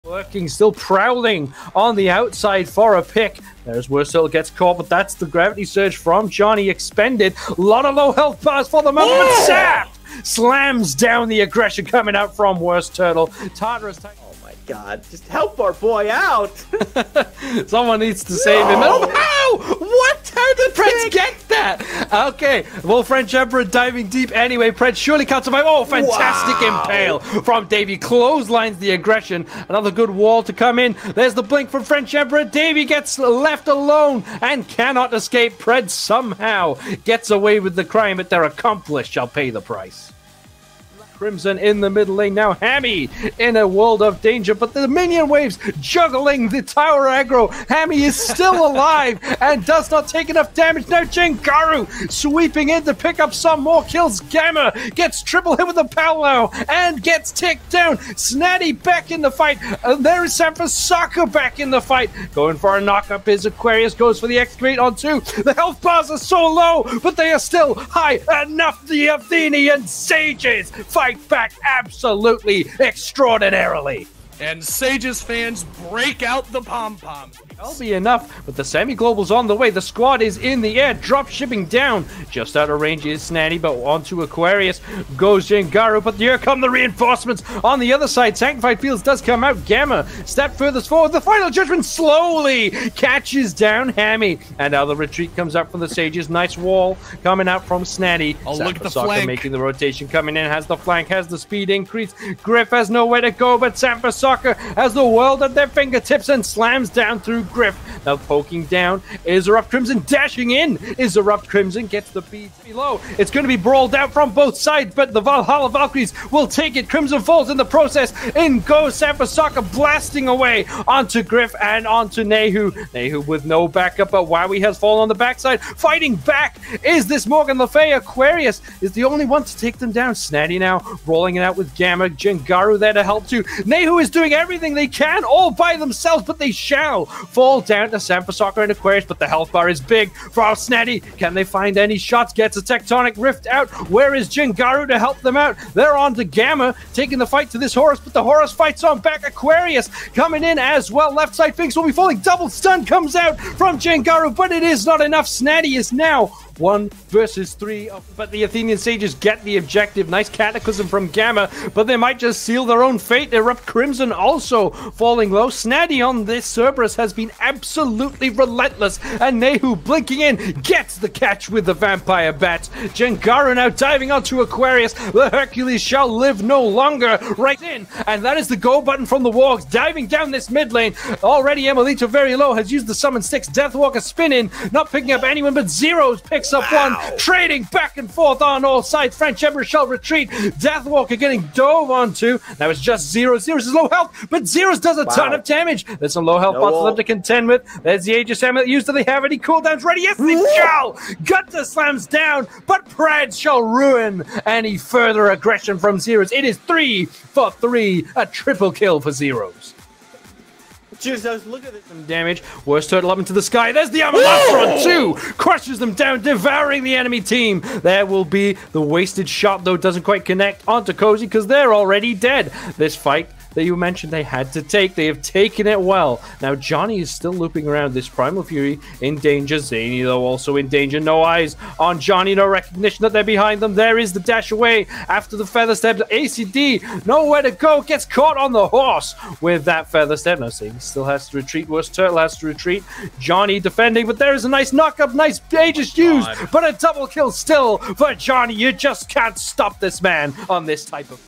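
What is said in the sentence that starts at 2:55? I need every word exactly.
The Hercules shall live no longer.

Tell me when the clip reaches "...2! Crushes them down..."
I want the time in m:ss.
3:34.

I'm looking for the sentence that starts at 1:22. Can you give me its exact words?
Just out of range is Snatty, but onto Aquarius goes Jengaru.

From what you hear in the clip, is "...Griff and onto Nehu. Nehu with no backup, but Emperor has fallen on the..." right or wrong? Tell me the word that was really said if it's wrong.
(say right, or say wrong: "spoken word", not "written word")
wrong: "Wowie", not "Emperor".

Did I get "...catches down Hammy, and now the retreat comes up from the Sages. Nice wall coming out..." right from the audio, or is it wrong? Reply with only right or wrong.
right.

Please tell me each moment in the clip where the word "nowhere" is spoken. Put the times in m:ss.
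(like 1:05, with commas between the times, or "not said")
1:42, 3:57.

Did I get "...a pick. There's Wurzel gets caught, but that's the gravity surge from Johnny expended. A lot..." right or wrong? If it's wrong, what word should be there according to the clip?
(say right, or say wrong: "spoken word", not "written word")
right.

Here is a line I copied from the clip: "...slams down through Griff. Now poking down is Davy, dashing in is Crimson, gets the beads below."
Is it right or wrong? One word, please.
wrong.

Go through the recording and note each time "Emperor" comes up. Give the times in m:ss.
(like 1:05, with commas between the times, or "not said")
0:23, 0:32, 3:09.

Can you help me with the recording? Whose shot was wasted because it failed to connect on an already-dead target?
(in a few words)
Cozy.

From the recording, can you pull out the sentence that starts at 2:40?
Nice cataclysm from Gamma, but they might just seal their own fate.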